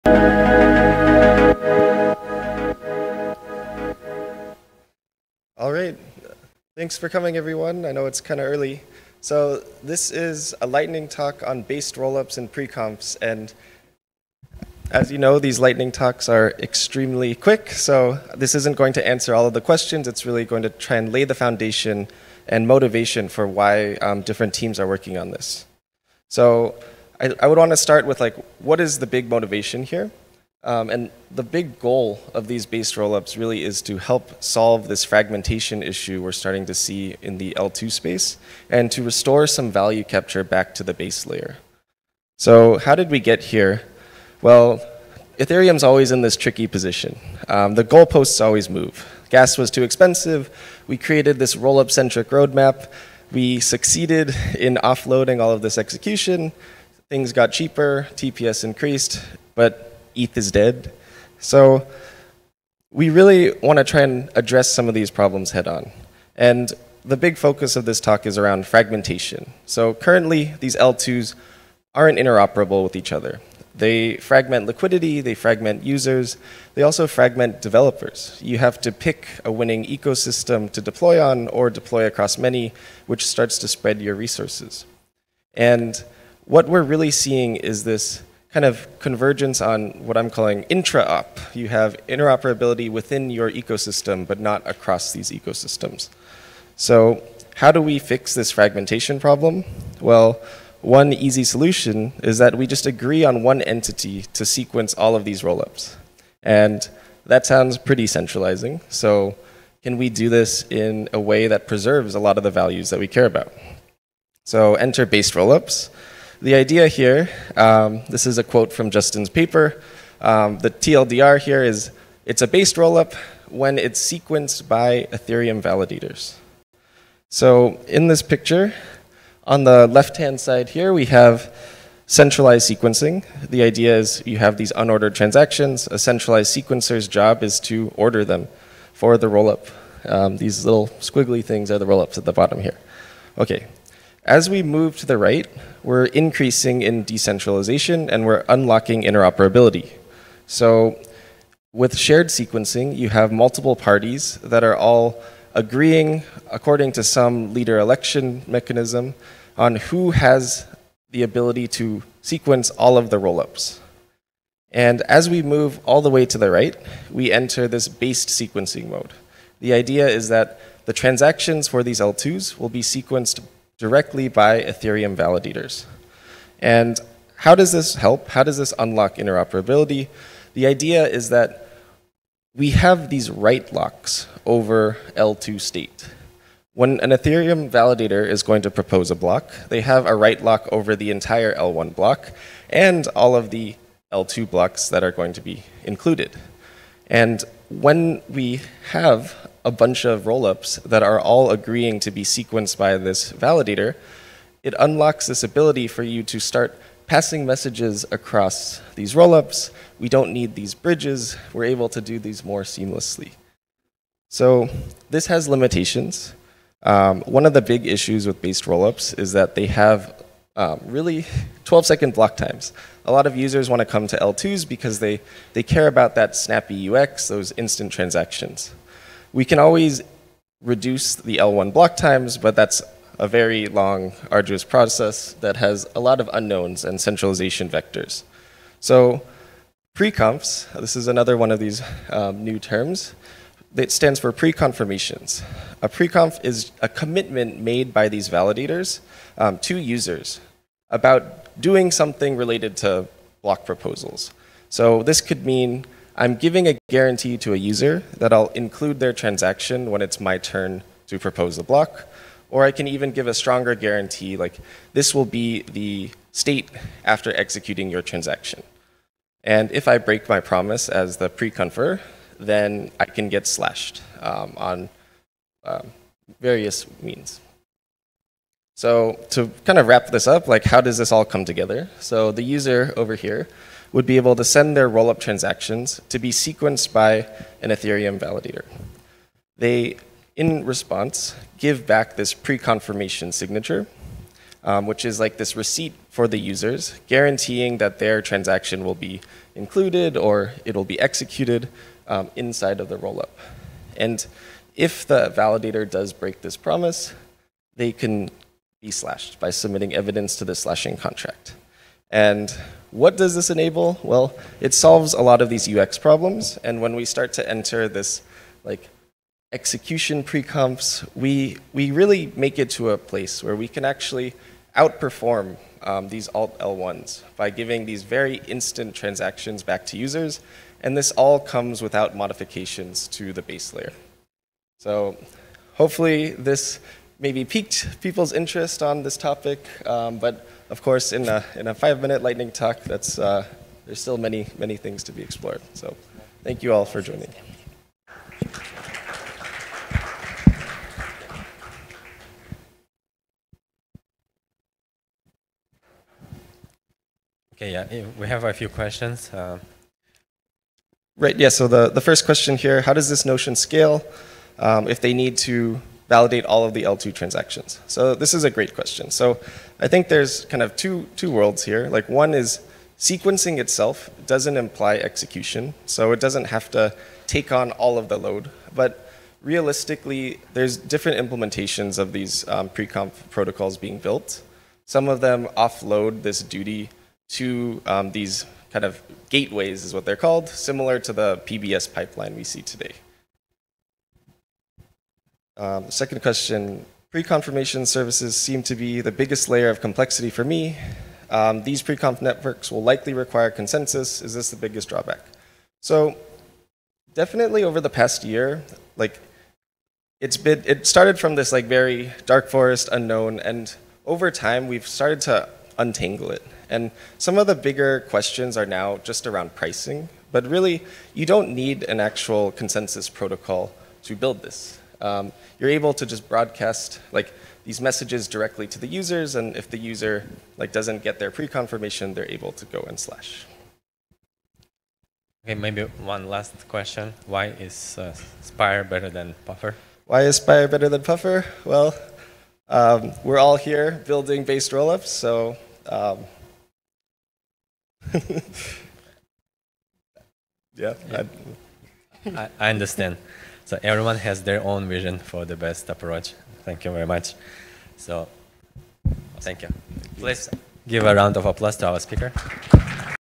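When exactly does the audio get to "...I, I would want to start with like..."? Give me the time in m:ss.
0:27.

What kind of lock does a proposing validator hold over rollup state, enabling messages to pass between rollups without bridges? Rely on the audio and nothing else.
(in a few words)
write locks.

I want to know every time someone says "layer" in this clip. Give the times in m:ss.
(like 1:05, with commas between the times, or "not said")
0:41, 5:33, 6:39.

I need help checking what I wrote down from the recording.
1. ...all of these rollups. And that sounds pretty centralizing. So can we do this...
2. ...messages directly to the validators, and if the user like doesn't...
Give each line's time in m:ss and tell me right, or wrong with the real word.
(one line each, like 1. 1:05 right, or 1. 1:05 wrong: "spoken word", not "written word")
1. 1:44 right
2. 7:07 wrong: "users", not "validators".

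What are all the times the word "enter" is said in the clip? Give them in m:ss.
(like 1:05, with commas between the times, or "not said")
1:54, 2:47, 5:17.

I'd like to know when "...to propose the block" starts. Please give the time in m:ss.
4:21.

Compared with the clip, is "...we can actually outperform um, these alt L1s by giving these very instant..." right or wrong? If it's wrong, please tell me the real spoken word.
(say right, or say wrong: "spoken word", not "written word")
right.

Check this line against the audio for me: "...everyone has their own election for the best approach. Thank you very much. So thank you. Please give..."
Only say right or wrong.
wrong.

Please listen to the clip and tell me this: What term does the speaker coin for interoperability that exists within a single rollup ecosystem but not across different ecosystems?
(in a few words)
intra-op.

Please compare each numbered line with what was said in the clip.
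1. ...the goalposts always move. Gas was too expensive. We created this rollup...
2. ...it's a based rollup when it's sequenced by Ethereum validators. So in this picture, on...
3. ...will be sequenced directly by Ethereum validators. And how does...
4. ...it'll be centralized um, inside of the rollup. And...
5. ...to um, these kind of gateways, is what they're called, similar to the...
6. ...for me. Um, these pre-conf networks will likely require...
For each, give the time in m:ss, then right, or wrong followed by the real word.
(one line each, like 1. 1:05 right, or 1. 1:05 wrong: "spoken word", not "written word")
1. 0:47 right
2. 2:02 right
3. 2:52 right
4. 5:00 wrong: "executed", not "centralized"
5. 6:27 right
6. 6:40 right.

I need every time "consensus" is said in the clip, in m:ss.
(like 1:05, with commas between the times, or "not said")
6:43, 7:02.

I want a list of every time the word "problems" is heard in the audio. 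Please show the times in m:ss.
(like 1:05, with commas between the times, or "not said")
1:05, 1:39, 5:15.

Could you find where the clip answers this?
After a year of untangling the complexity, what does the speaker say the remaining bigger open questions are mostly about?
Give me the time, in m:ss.
6:59.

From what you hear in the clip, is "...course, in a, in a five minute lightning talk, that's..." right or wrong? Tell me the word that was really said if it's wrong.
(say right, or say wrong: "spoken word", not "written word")
right.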